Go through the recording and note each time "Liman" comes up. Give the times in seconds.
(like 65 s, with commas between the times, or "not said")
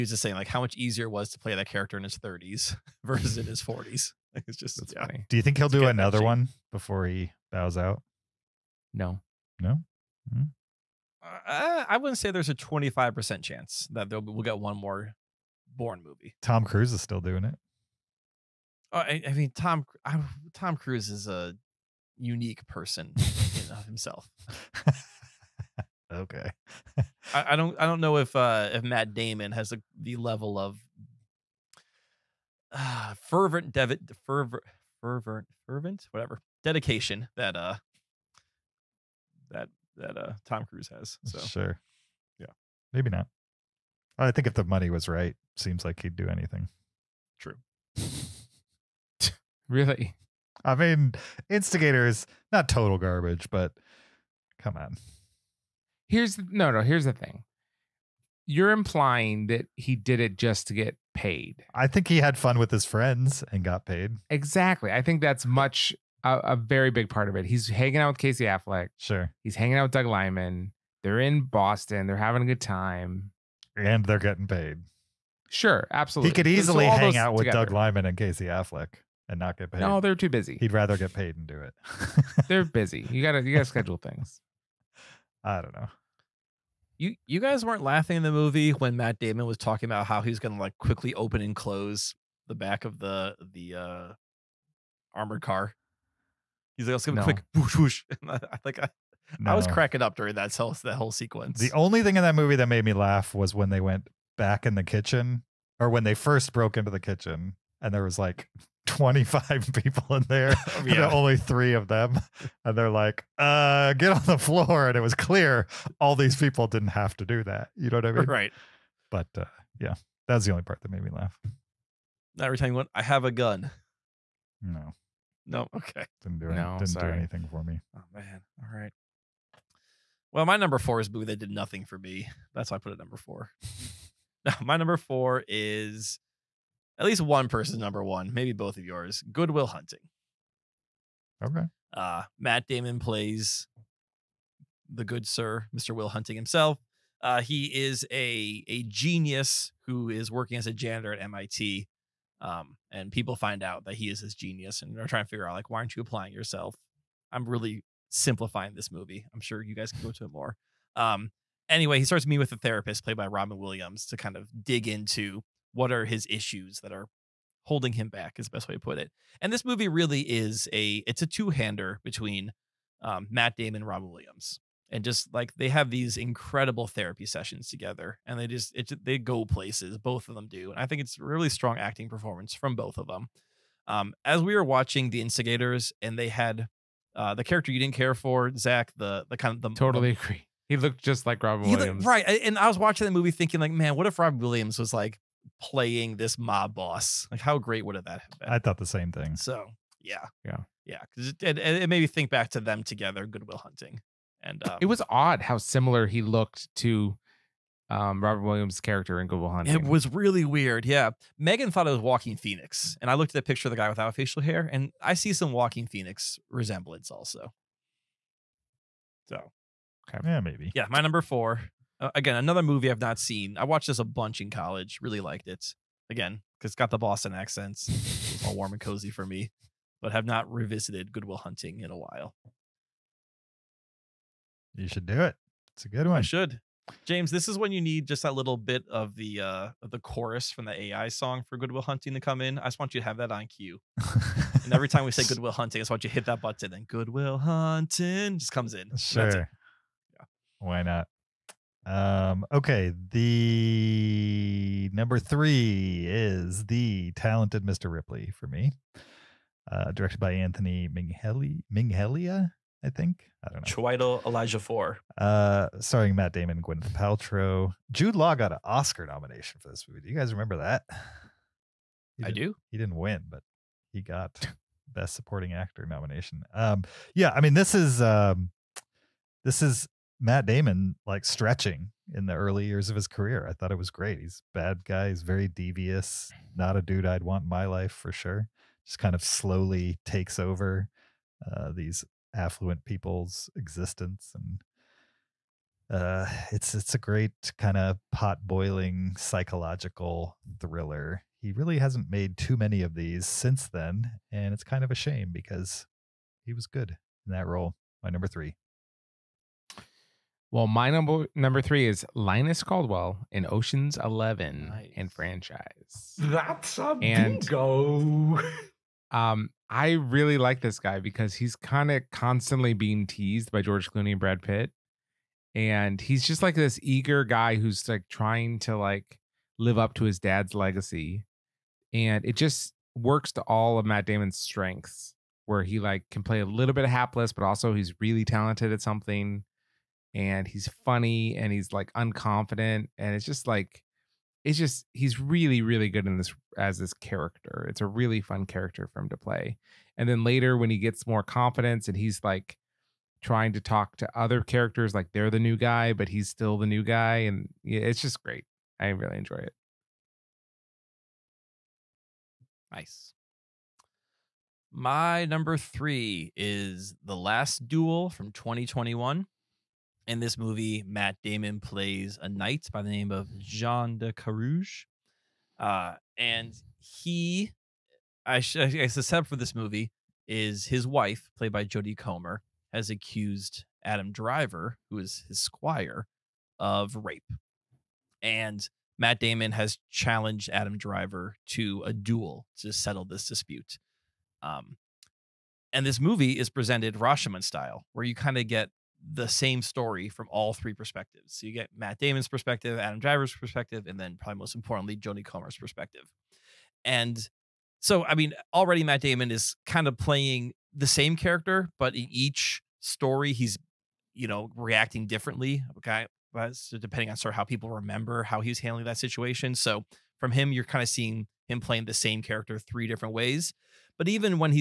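70 s, 77 s.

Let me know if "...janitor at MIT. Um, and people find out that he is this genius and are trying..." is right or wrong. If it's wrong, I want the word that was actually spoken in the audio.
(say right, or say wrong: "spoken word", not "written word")
right.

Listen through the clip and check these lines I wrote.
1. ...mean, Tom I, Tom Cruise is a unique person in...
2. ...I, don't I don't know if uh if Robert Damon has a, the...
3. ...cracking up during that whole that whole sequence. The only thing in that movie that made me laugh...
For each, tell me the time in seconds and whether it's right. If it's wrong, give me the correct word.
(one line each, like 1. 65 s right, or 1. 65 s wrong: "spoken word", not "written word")
1. 19 s right
2. 27 s wrong: "Matt", not "Robert"
3. 99 s right.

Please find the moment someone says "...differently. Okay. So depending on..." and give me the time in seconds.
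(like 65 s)
415 s.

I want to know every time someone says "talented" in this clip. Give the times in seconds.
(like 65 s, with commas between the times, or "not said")
257 s, 338 s.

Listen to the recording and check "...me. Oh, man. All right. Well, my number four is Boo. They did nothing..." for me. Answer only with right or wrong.
right.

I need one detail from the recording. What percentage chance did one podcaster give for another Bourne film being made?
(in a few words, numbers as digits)
25 percent.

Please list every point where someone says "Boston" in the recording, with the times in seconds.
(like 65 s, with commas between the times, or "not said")
71 s, 226 s.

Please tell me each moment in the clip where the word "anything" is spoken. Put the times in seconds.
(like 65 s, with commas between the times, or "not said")
46 s, 127 s.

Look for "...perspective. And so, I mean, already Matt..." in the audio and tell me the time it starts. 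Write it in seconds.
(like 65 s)
405 s.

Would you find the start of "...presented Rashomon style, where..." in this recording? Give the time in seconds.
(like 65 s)
396 s.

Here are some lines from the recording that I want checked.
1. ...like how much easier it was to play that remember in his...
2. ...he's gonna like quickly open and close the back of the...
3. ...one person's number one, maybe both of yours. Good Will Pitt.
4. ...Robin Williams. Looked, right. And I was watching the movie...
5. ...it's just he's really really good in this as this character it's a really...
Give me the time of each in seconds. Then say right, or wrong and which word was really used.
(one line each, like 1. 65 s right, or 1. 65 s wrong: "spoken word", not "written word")
1. 0 s wrong: "character", not "remember"
2. 90 s right
3. 137 s wrong: "Hunting", not "Pitt"
4. 191 s right
5. 344 s right.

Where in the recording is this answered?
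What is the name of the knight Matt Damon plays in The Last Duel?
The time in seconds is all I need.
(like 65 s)
373 s.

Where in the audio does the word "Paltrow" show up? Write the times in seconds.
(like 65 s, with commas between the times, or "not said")
266 s.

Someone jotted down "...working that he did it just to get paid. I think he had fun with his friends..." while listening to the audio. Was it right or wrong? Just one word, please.
wrong.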